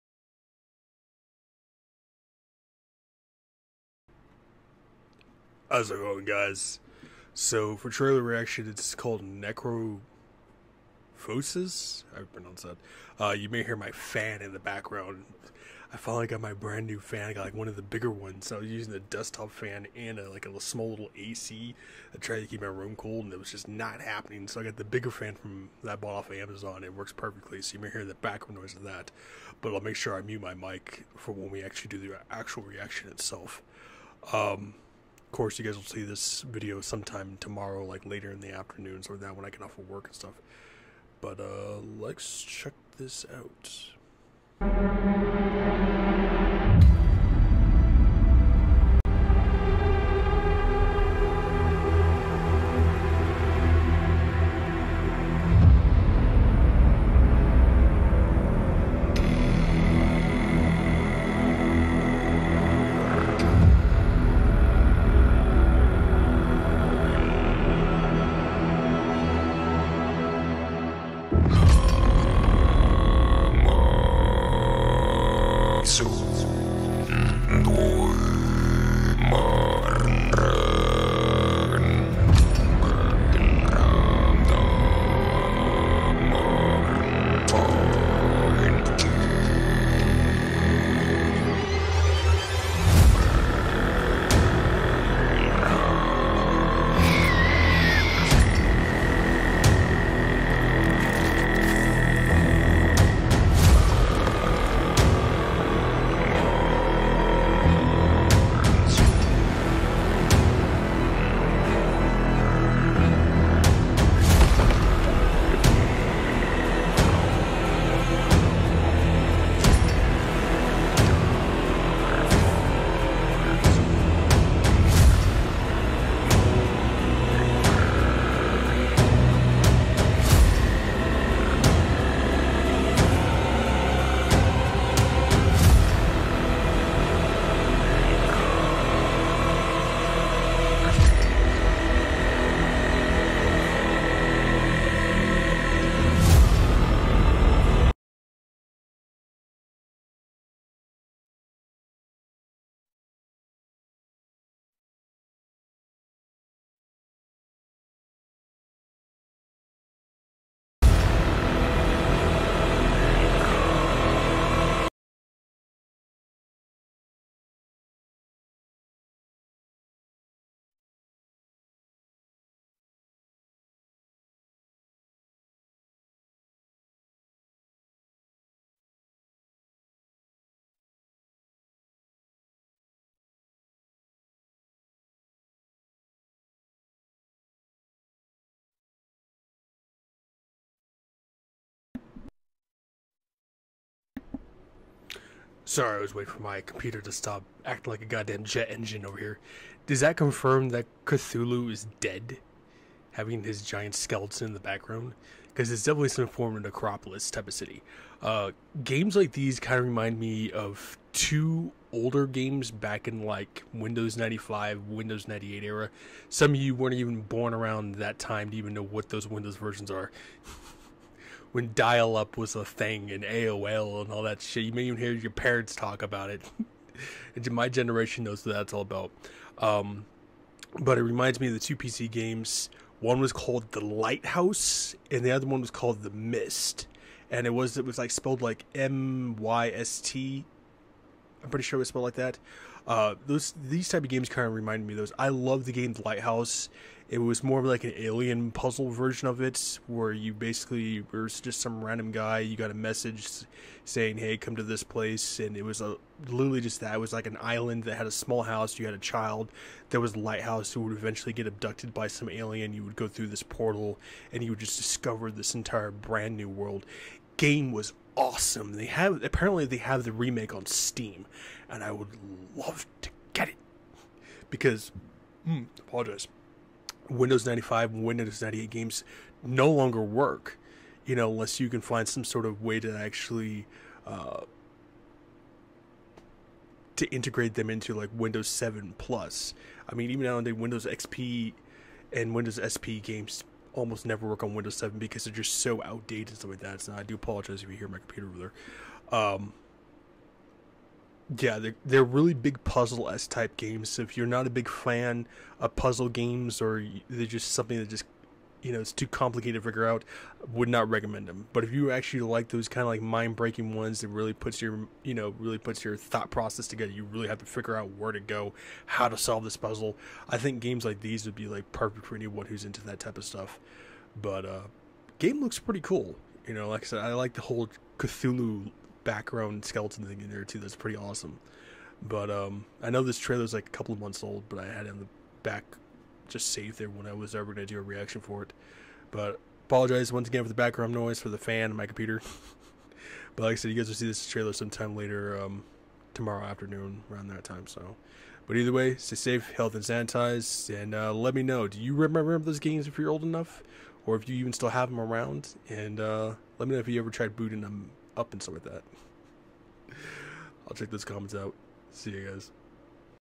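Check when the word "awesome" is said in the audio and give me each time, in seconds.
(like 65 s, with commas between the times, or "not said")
268 s, 330 s.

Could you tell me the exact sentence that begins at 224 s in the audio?
You may even hear your parents talk about it.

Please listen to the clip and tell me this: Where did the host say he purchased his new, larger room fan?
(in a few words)
Amazon.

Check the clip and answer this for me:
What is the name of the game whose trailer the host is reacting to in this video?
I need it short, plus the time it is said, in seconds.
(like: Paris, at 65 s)
Necrophosis, at 9 s.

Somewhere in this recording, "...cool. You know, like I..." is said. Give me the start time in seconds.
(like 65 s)
325 s.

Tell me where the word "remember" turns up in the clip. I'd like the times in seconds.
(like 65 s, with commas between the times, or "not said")
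351 s.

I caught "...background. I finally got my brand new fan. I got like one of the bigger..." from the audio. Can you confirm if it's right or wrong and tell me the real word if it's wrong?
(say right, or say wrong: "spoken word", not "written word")
right.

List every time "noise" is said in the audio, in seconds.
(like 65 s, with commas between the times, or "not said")
28 s, 340 s.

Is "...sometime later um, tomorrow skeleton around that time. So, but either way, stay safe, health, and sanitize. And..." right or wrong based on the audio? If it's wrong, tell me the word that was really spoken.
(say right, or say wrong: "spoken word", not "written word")
wrong: "afternoon", not "skeleton".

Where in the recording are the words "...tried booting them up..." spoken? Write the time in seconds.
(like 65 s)
357 s.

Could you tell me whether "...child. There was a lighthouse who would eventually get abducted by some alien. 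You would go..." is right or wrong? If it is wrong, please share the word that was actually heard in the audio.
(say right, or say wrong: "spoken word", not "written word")
right.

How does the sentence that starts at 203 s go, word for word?
Having his giant skeleton in the background?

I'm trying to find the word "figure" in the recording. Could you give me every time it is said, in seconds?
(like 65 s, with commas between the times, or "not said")
309 s, 317 s.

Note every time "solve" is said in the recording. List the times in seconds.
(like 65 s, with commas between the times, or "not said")
319 s.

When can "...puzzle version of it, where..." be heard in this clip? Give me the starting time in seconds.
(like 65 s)
248 s.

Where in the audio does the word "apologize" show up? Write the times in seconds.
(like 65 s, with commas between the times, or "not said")
275 s, 297 s, 339 s.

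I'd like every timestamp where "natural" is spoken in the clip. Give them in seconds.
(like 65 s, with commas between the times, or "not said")
not said.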